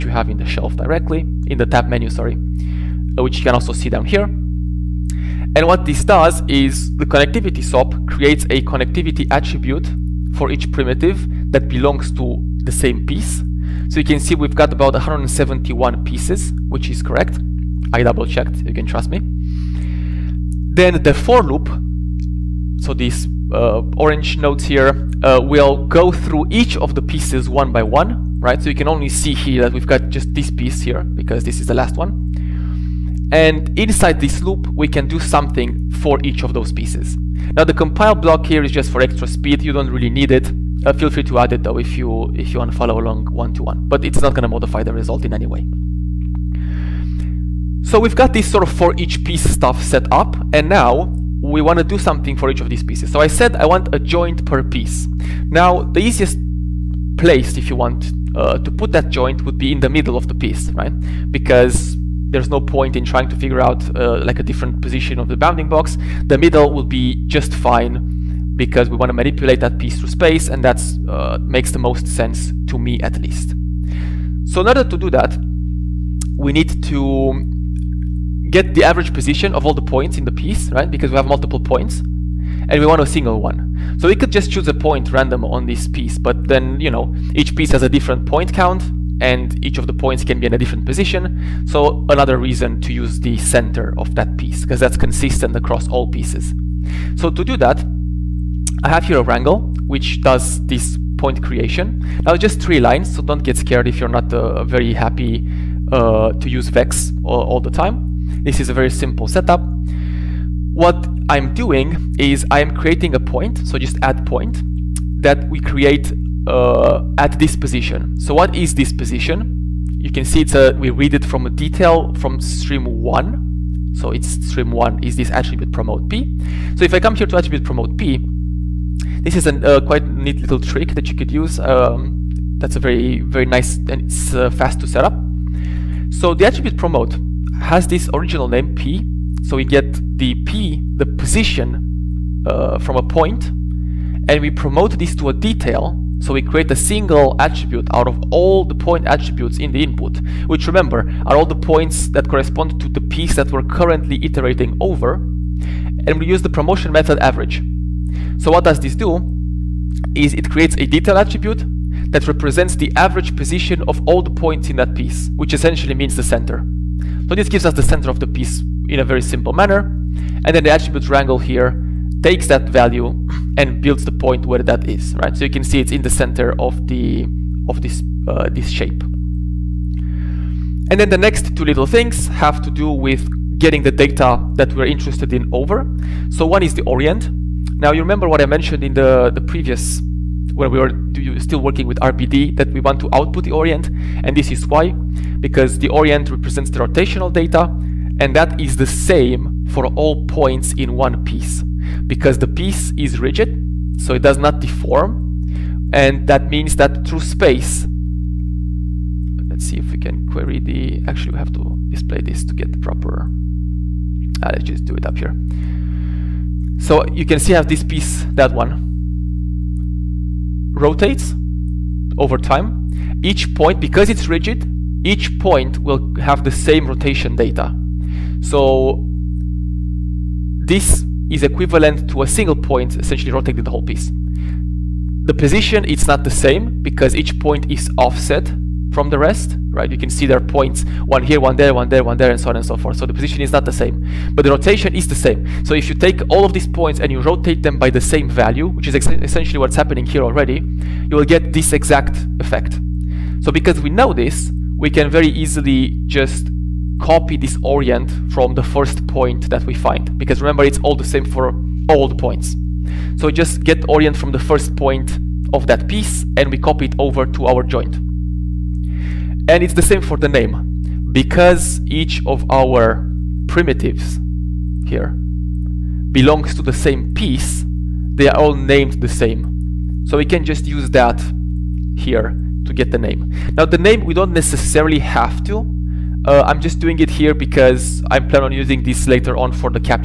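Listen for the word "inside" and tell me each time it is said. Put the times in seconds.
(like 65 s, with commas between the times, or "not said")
33 s.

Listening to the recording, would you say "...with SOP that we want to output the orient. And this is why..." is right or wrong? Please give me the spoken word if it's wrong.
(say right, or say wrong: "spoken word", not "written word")
wrong: "RBD", not "SOP".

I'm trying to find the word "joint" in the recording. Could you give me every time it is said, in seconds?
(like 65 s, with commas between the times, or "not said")
53 s, 59 s, 267 s.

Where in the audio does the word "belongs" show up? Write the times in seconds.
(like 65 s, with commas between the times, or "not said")
11 s, 276 s.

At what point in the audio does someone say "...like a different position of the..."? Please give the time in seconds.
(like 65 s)
64 s.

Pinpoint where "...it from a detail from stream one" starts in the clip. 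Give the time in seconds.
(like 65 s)
121 s.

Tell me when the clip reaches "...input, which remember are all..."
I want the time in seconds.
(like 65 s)
149 s.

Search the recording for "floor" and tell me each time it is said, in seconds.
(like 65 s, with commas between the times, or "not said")
not said.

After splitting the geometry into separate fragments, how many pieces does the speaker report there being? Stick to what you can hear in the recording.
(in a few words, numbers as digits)
171.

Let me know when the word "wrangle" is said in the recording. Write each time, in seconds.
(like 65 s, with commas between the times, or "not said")
99 s, 171 s.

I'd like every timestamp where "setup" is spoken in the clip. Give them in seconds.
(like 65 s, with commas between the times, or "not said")
109 s.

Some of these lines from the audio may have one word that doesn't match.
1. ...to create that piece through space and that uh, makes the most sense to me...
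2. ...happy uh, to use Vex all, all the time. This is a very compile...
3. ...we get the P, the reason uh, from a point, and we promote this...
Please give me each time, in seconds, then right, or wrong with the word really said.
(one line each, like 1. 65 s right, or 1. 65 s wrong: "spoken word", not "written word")
1. 69 s wrong: "manipulate", not "create"
2. 104 s wrong: "simple", not "compile"
3. 139 s wrong: "position", not "reason".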